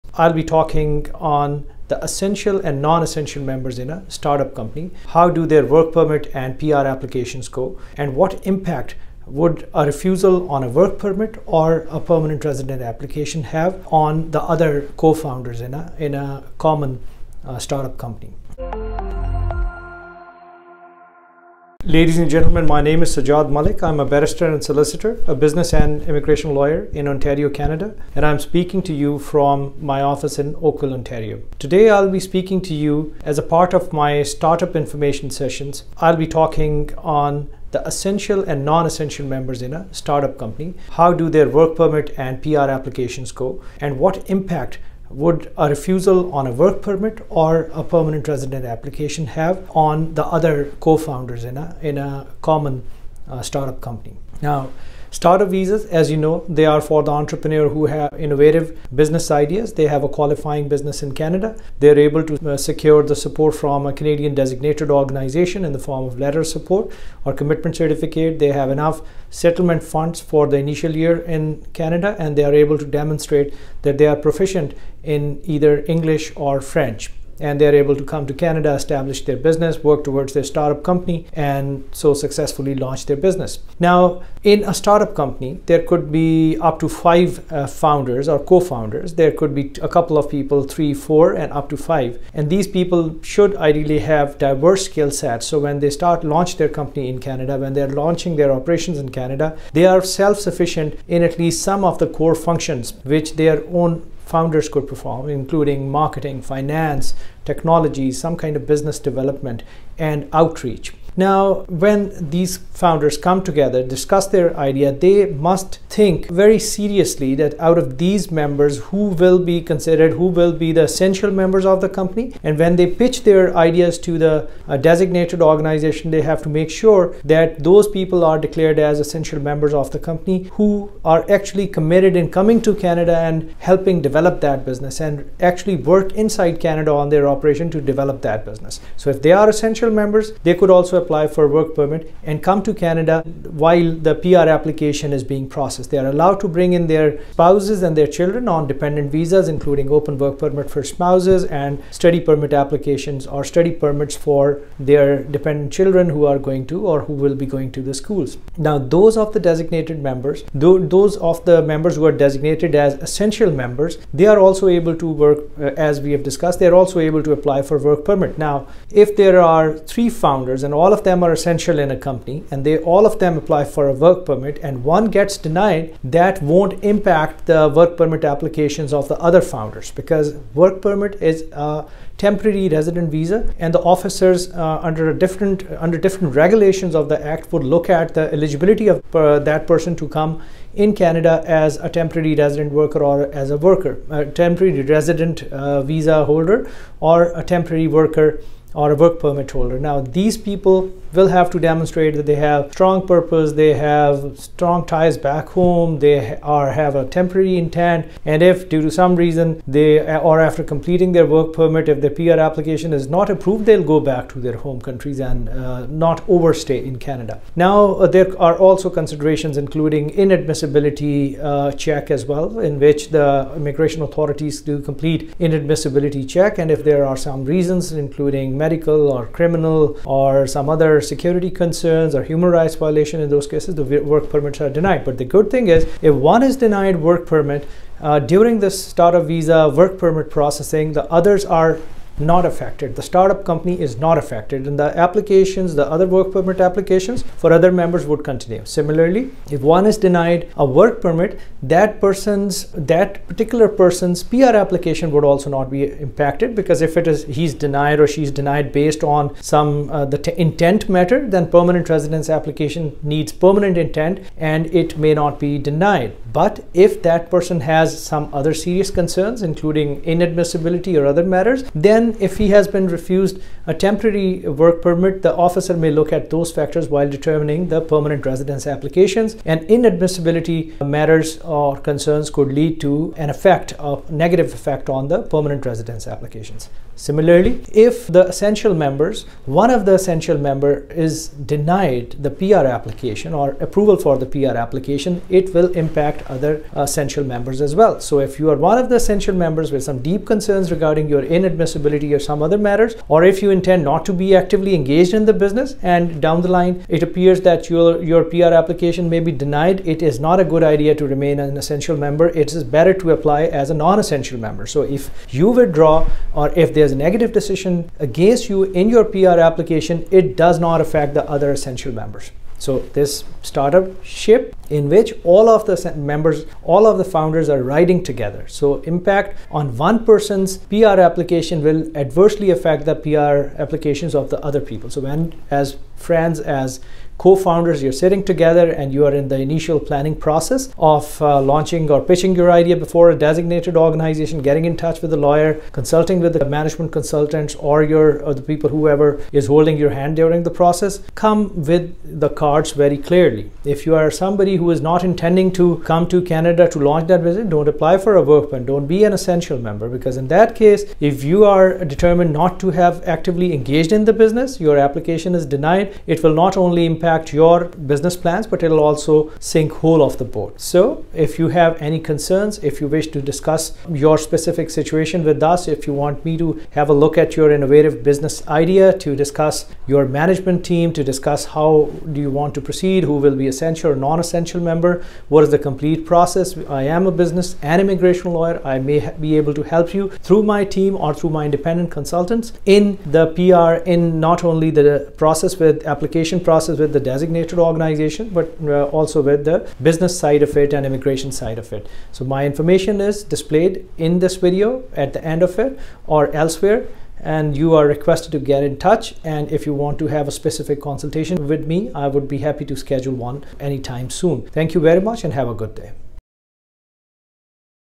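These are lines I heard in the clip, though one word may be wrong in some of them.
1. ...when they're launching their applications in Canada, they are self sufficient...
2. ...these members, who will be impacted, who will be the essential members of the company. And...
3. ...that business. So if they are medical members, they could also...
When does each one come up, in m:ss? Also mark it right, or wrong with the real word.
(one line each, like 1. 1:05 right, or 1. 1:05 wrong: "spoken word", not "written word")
1. 1:37 wrong: "operations", not "applications"
2. 1:57 wrong: "considered", not "impacted"
3. 2:18 wrong: "essential", not "medical".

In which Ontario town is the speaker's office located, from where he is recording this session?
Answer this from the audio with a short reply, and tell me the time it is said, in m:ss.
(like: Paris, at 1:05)
Oakville, at 0:30.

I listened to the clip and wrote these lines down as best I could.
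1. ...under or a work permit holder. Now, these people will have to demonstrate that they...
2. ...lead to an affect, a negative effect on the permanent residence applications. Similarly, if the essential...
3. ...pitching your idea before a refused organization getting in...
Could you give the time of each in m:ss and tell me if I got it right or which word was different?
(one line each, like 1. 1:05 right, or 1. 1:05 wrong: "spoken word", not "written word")
1. 3:17 wrong: "worker", not "under"
2. 4:42 wrong: "effect", not "affect"
3. 5:42 wrong: "designated", not "refused".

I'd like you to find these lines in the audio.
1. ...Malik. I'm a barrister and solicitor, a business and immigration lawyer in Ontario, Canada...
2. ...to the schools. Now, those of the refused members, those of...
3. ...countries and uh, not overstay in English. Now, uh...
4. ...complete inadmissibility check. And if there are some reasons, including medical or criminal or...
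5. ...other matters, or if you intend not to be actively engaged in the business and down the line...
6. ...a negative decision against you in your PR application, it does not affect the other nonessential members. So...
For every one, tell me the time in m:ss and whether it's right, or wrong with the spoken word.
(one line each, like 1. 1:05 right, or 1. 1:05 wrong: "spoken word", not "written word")
1. 0:23 right
2. 2:37 wrong: "designated", not "refused"
3. 3:34 wrong: "Canada", not "English"
4. 3:44 right
5. 5:02 right
6. 5:16 wrong: "essential", not "nonessential".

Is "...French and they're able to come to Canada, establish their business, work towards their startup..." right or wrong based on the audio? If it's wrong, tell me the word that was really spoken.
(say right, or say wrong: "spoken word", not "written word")
right.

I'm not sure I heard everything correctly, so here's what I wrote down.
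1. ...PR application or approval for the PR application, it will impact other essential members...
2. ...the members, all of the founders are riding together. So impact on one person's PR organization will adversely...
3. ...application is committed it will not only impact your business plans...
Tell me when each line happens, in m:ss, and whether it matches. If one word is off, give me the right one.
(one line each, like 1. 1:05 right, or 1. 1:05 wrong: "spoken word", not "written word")
1. 4:52 right
2. 5:25 wrong: "application", not "organization"
3. 6:04 wrong: "denied", not "committed".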